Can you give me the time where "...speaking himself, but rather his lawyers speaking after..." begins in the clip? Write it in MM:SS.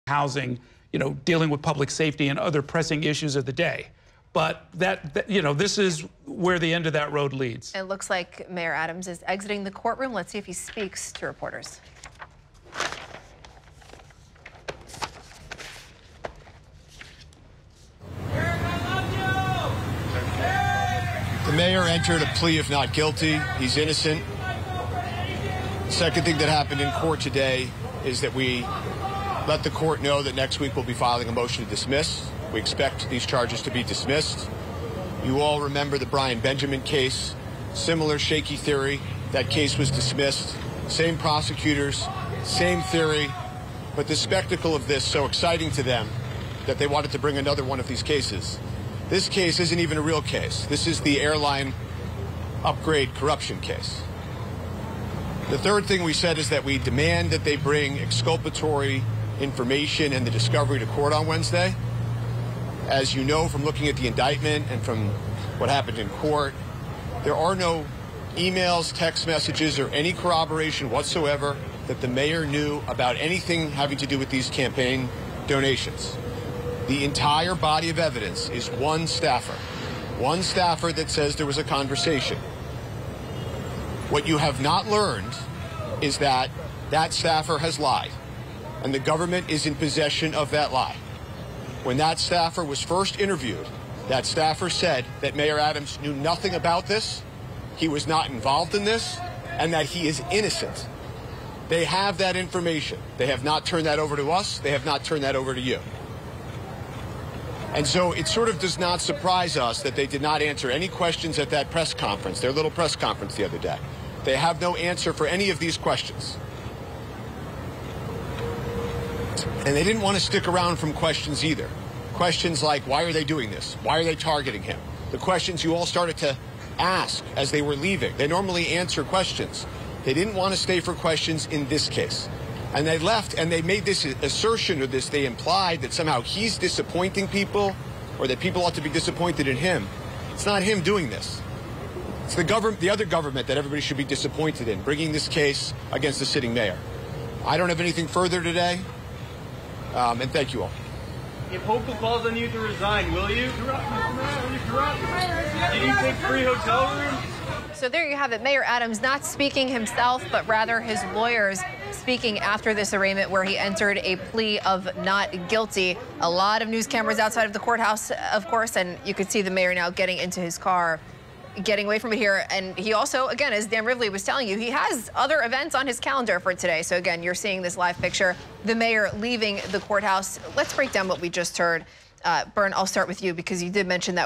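02:39.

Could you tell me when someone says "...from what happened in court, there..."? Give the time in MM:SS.
01:04.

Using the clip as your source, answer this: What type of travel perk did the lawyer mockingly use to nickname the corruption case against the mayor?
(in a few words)
Airline upgrade.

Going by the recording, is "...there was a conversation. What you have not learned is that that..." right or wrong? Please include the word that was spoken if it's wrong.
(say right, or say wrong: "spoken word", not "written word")
right.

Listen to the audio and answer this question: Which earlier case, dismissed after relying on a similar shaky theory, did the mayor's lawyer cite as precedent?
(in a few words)
Brian Benjamin case.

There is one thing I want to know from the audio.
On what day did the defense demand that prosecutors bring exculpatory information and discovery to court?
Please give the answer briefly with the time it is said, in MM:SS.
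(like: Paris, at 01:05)
Wednesday, at 01:01.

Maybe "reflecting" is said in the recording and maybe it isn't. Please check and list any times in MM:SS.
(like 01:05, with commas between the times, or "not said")
not said.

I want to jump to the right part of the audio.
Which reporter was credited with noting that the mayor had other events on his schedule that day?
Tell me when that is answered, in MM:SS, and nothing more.
02:53.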